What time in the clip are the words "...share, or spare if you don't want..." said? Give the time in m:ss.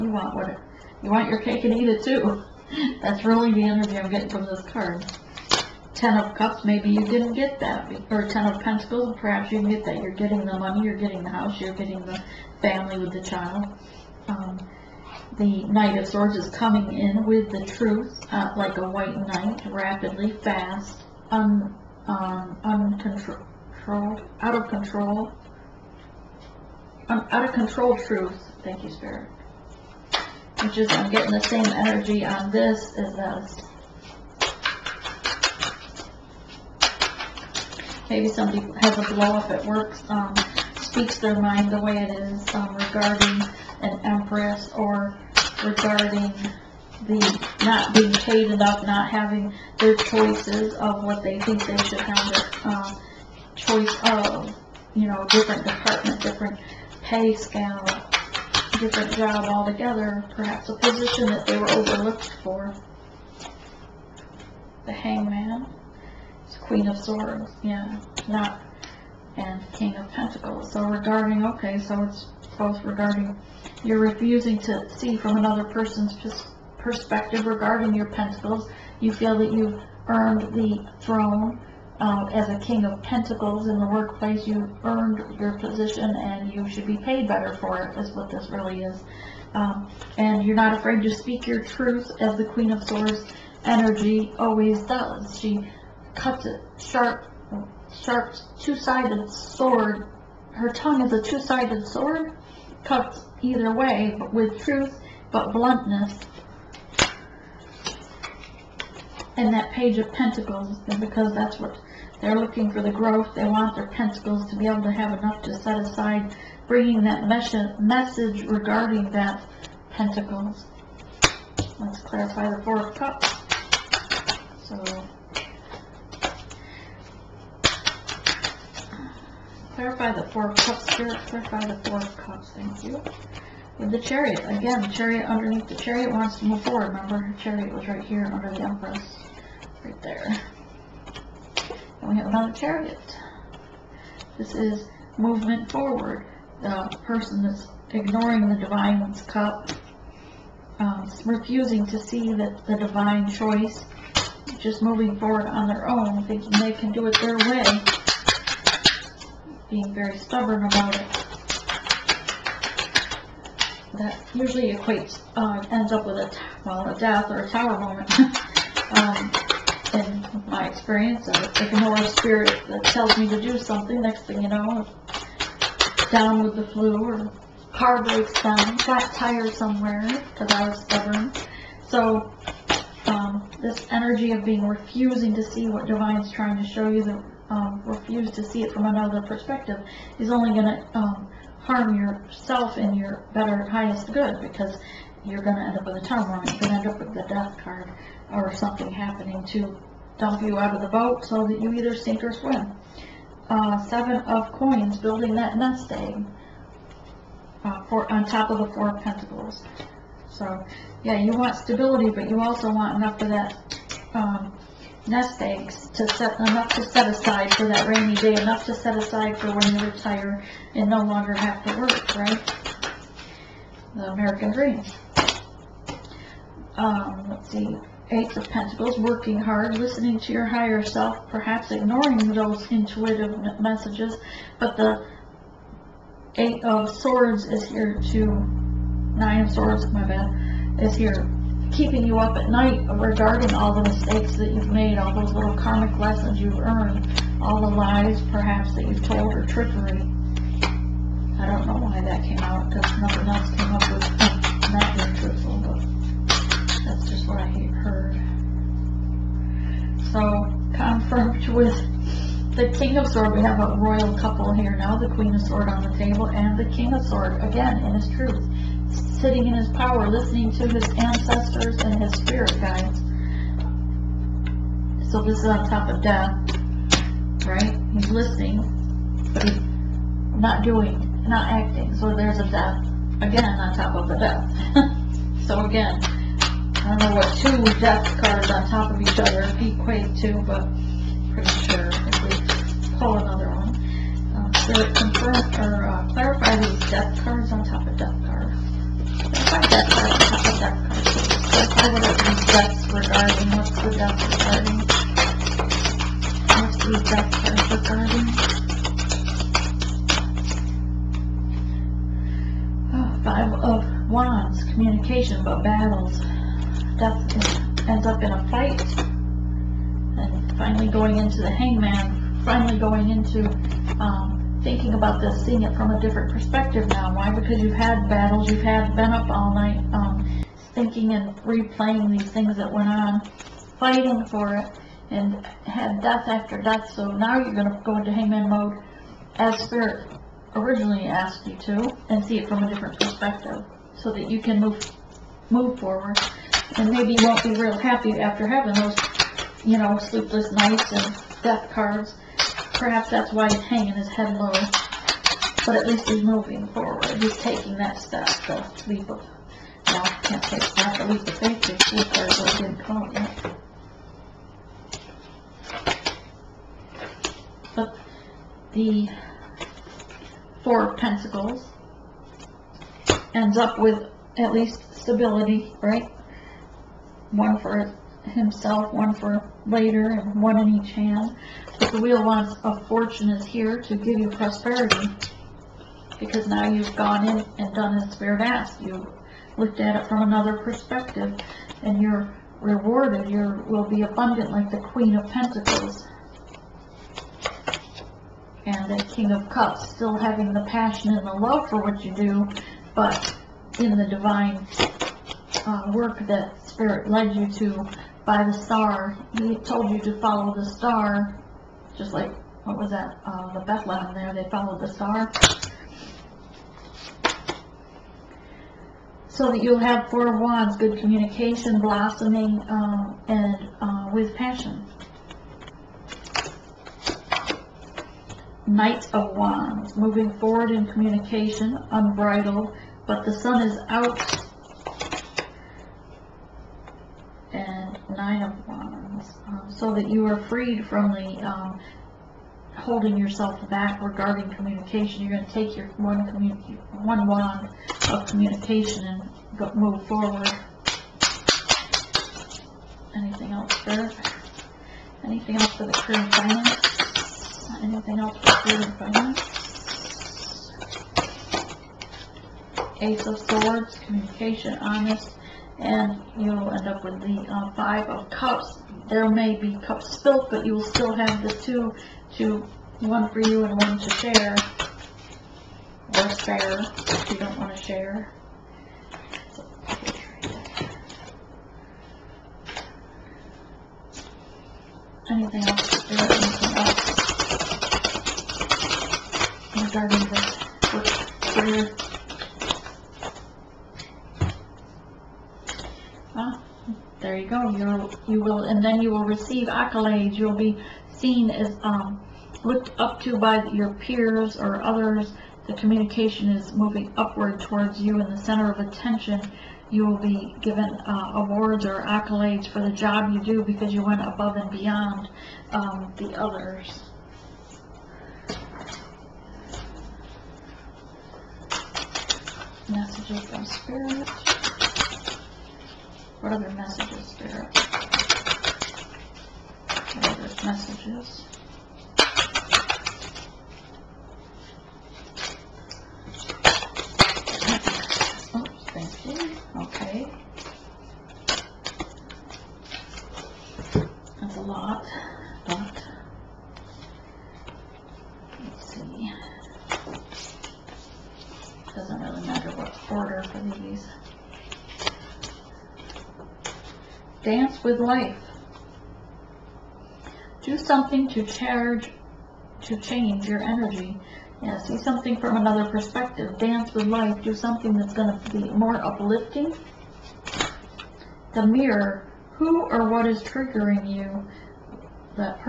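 7:54.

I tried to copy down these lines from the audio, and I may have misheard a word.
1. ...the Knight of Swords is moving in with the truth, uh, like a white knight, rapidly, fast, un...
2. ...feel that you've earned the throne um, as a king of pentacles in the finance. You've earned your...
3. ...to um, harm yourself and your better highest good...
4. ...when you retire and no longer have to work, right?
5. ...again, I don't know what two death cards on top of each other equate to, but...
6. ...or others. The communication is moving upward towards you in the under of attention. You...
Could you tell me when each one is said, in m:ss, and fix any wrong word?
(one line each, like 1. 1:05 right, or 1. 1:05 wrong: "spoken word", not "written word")
1. 0:15 wrong: "coming", not "moving"
2. 1:19 wrong: "workplace", not "finance"
3. 3:10 right
4. 3:39 right
5. 4:45 right
6. 8:24 wrong: "center", not "under".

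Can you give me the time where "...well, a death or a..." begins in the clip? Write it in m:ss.
2:46.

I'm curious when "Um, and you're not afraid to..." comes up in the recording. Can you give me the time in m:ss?
1:29.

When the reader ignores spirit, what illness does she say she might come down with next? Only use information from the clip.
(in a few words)
the flu.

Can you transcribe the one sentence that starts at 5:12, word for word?
Oh, five of Wands, communication but battles.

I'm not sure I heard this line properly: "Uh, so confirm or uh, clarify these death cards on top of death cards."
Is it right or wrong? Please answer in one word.
right.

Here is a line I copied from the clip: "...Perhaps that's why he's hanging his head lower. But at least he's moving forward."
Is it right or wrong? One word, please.
right.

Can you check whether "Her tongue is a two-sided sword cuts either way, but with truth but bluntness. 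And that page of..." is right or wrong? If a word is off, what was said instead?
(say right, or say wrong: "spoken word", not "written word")
right.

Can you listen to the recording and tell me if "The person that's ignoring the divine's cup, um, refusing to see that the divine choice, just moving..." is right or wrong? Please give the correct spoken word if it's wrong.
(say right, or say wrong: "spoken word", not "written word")
right.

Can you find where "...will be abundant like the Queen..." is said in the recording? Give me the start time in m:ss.
6:33.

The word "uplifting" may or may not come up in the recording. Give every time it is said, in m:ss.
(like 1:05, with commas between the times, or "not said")
9:29.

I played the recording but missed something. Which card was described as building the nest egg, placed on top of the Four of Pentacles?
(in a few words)
seven of coins.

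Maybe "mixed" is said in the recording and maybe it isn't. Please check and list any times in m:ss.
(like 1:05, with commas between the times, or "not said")
not said.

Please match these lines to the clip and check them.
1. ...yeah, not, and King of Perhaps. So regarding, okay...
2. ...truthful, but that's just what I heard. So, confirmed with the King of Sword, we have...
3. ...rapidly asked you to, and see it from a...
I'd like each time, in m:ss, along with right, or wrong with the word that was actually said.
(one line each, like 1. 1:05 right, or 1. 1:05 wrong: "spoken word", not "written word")
1. 1:07 wrong: "Pentacles", not "Perhaps"
2. 4:15 right
3. 5:40 wrong: "originally", not "rapidly".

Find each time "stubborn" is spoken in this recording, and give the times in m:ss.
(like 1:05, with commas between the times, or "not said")
2:40, 3:00.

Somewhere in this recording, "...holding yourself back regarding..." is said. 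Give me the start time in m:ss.
7:22.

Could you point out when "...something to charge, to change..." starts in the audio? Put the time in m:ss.
9:20.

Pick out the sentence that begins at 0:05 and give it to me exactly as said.
Ten of Cups, maybe you didn't get that, or Ten of Pentacles, perhaps you didn't get that.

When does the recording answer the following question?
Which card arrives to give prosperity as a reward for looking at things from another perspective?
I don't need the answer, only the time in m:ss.
6:22.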